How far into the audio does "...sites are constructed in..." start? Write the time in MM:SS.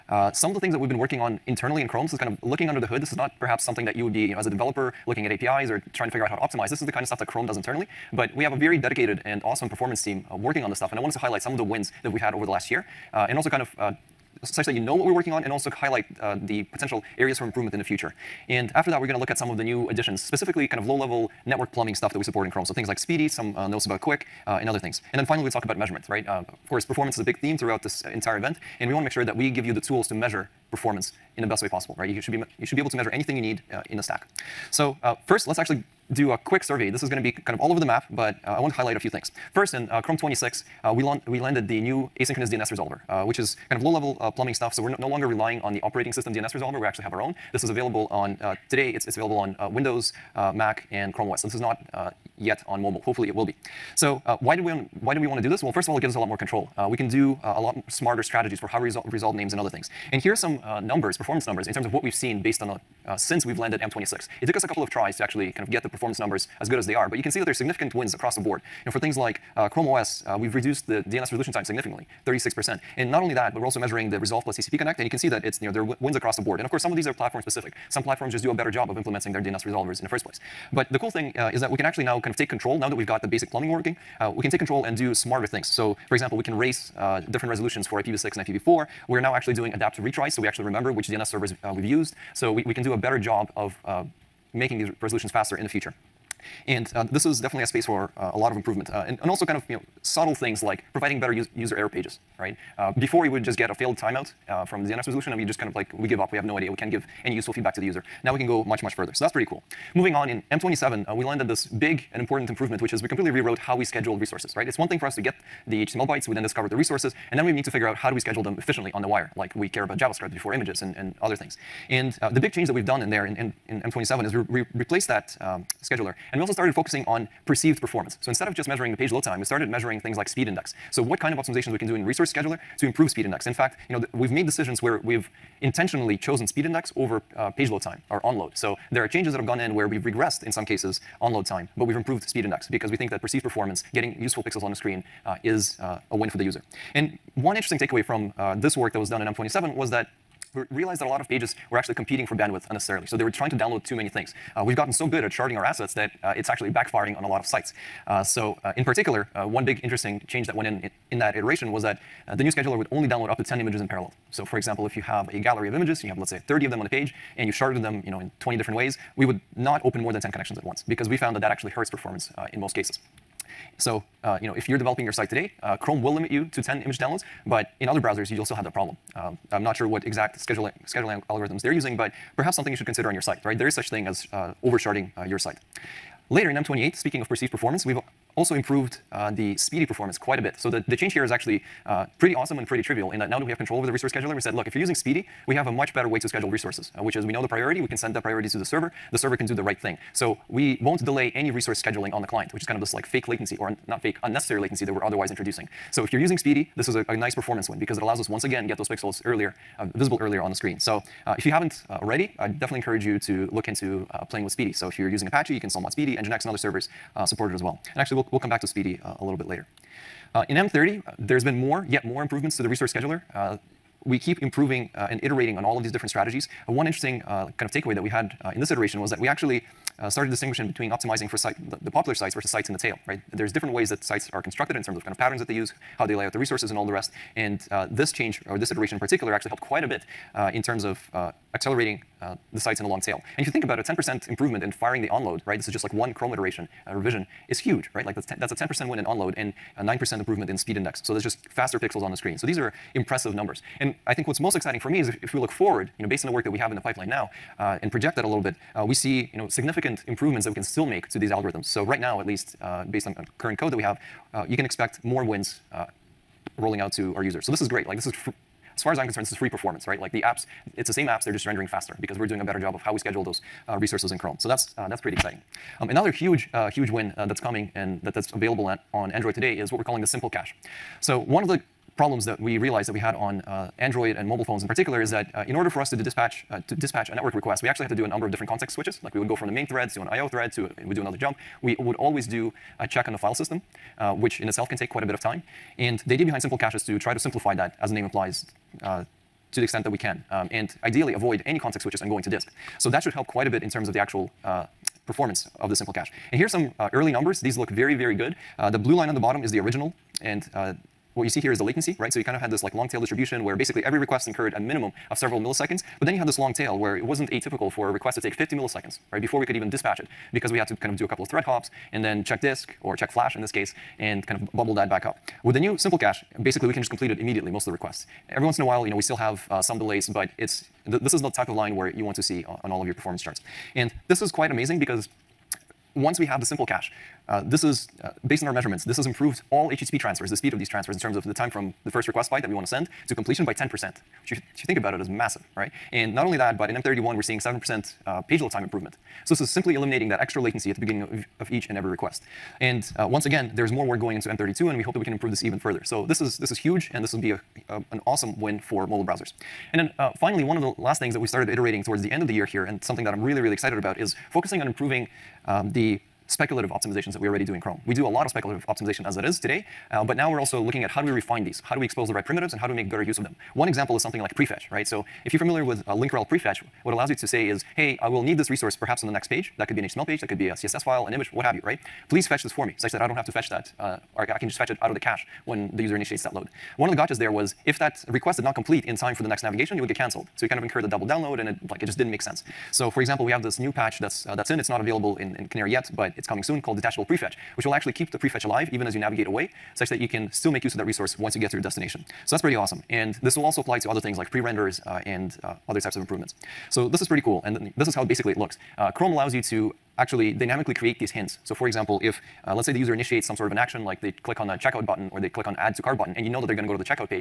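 03:54.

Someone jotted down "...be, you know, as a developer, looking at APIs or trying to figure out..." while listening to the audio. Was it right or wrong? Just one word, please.
right.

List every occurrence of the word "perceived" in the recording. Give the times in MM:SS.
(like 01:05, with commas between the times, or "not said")
02:07, 02:23, 03:07.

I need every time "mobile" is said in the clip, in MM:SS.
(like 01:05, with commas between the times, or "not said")
00:52, 04:44, 05:58.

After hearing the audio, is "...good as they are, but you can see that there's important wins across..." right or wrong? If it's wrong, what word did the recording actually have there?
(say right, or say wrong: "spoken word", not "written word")
wrong: "significant", not "important".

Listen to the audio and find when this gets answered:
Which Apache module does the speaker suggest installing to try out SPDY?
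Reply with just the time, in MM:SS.
03:35.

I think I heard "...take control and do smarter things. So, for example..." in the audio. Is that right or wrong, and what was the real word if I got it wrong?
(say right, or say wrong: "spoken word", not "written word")
right.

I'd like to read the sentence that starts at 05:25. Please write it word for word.
With the new simple cache, basically we can just complete it immediately most of the requests.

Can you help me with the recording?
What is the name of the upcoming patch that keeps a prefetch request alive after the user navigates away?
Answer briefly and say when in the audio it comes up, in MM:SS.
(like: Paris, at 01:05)
Detachable Prefetch, at 06:36.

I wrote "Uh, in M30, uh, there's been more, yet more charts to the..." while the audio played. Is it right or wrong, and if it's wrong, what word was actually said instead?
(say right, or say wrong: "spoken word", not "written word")
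wrong: "improvements", not "charts".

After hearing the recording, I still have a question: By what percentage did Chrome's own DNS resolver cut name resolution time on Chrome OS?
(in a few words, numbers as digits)
36%.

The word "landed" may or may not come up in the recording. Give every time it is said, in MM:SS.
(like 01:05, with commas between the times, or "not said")
00:41, 01:03, 01:51.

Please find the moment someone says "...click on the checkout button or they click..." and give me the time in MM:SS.
06:54.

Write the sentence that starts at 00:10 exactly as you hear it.
And I wanted to highlight some of the wins that we had over the last year.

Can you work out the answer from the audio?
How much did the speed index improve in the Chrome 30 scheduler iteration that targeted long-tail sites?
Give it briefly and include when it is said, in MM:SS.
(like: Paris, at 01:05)
9%, at 04:09.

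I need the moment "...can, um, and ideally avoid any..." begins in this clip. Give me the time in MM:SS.
05:00.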